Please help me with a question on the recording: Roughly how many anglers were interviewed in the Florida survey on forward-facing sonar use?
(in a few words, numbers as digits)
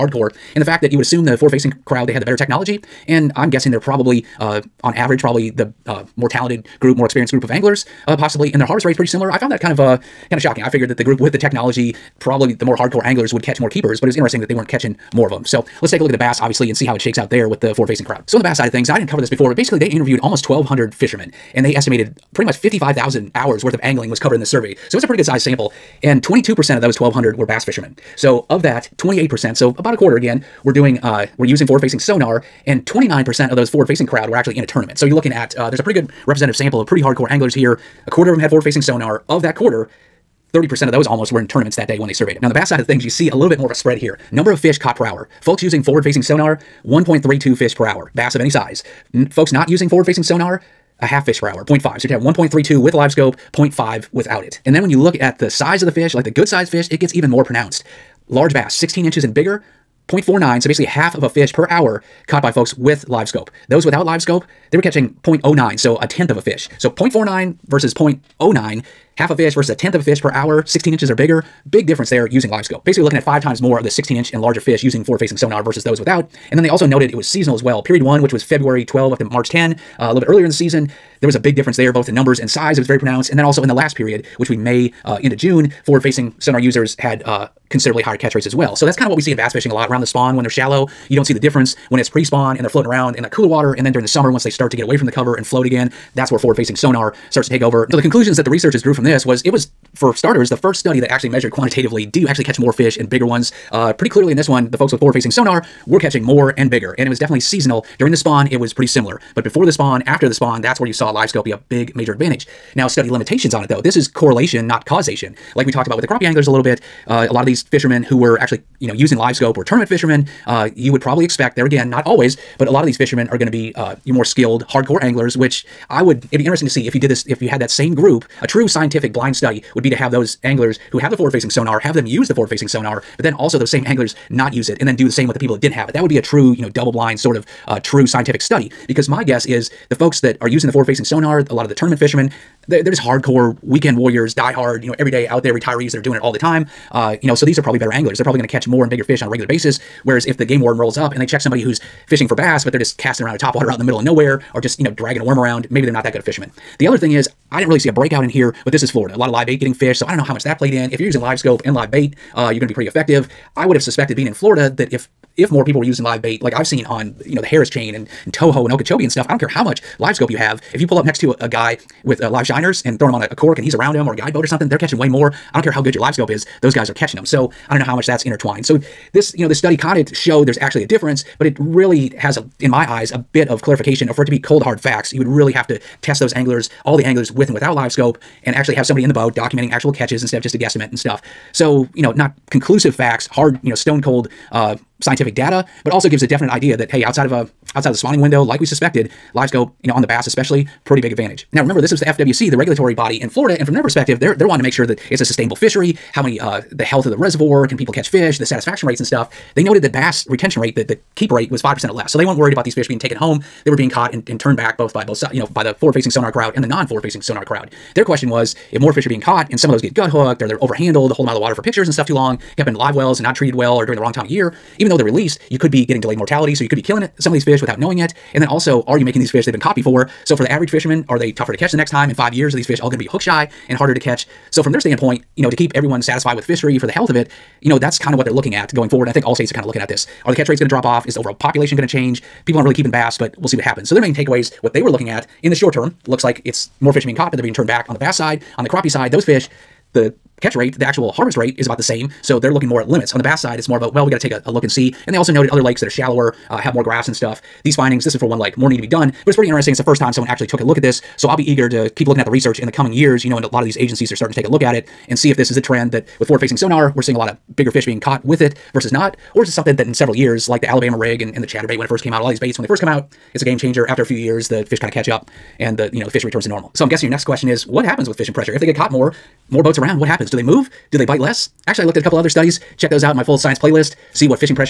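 1,200.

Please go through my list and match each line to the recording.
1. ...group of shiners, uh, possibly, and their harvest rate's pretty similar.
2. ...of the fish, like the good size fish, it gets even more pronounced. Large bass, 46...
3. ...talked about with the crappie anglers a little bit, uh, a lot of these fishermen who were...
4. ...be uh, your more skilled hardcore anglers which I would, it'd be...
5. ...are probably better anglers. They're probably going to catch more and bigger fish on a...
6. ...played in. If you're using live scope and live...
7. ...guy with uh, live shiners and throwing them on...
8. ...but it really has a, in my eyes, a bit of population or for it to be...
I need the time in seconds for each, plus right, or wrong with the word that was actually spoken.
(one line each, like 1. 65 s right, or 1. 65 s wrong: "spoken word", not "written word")
1. 7 s wrong: "anglers", not "shiners"
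2. 55 s wrong: "16", not "46"
3. 115 s right
4. 123 s right
5. 147 s right
6. 160 s right
7. 171 s right
8. 181 s wrong: "clarification", not "population".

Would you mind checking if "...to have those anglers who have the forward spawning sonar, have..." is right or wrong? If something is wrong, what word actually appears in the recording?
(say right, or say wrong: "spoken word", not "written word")
wrong: "facing", not "spawning".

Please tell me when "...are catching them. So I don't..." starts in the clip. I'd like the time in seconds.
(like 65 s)
176 s.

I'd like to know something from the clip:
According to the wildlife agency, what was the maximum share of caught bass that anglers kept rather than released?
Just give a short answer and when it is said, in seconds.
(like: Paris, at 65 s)
5%, at 211 s.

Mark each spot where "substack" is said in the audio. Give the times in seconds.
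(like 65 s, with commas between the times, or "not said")
not said.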